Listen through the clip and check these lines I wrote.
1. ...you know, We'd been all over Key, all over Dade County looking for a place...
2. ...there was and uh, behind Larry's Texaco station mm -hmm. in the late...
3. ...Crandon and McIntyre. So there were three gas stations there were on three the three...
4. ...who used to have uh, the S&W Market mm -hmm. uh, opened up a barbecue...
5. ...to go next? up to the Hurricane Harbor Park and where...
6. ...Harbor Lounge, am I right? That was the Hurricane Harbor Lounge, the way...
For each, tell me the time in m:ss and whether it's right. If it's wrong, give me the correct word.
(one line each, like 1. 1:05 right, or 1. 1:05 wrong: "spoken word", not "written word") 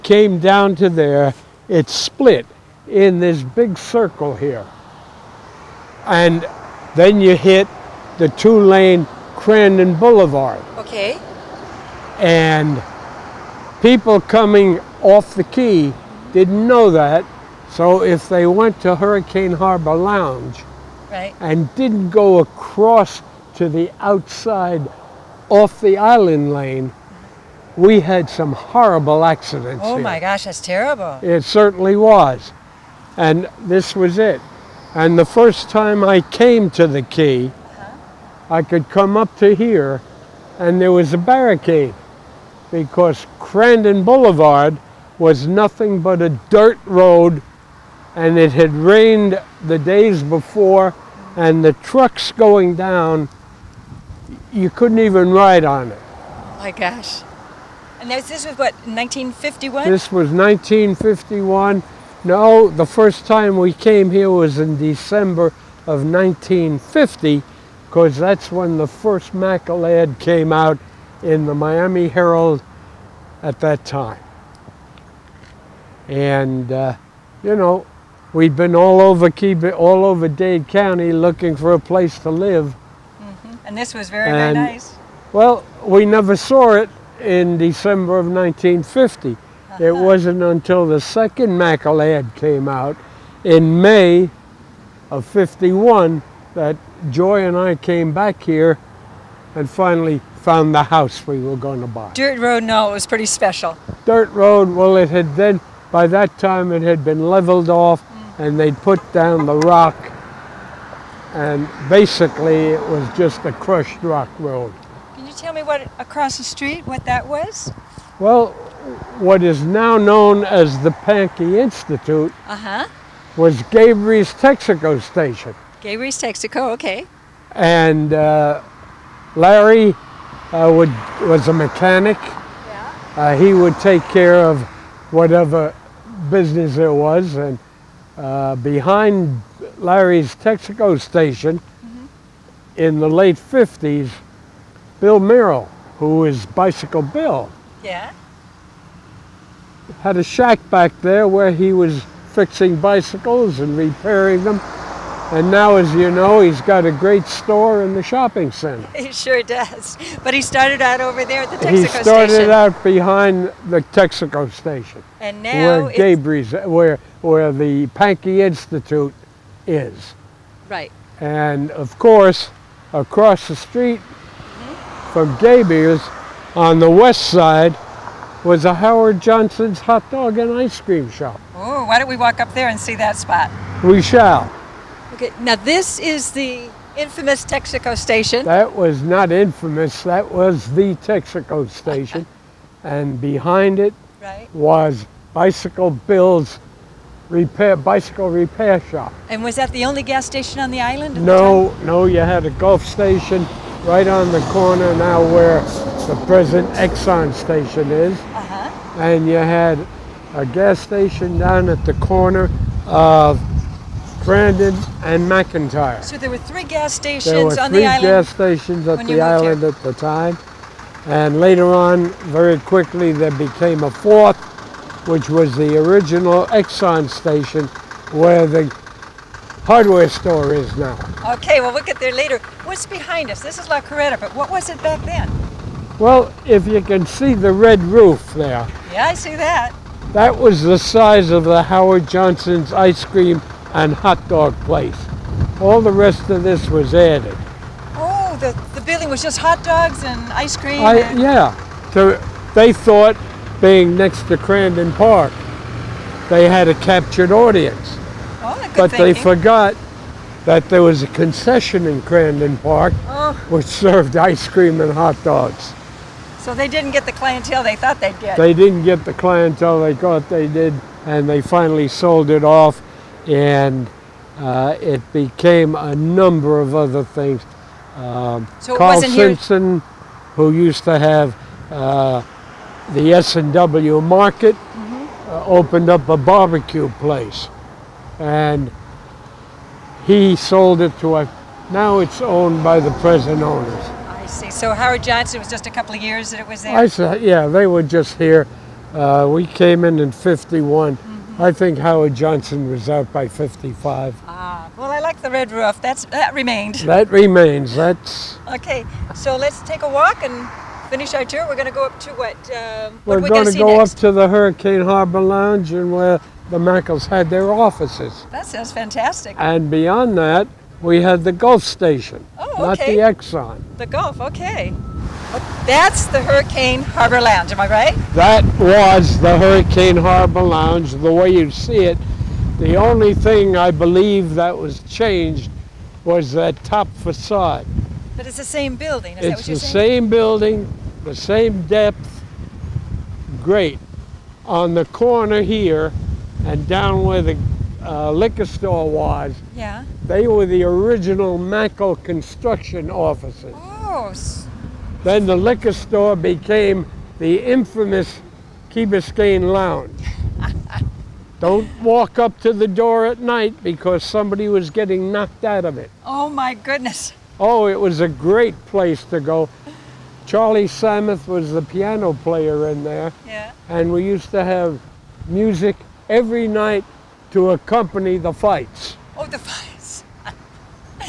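1. 1:17 right
2. 2:16 right
3. 3:34 right
4. 4:40 right
5. 5:13 wrong: "Lounge", not "Park"
6. 5:26 right.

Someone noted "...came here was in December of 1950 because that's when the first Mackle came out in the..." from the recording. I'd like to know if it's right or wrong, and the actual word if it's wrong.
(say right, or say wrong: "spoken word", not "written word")
right.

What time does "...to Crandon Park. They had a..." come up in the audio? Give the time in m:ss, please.
4:14.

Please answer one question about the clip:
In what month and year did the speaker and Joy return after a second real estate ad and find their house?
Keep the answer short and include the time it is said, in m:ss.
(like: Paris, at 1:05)
May 1951, at 1:33.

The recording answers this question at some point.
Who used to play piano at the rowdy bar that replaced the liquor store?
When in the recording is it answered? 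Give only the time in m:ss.
6:10.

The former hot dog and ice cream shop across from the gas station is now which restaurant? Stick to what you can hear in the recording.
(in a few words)
La Carreta.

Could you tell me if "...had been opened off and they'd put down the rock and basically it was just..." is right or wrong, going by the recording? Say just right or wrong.
wrong.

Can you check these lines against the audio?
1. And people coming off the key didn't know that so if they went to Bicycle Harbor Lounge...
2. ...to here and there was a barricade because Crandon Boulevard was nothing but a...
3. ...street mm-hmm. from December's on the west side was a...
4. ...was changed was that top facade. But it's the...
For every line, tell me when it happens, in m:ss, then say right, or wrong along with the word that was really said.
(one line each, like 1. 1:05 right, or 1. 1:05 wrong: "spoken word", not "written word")
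1. 0:12 wrong: "Hurricane", not "Bicycle"
2. 0:39 right
3. 2:53 wrong: "Gabriel", not "December"
4. 5:34 right.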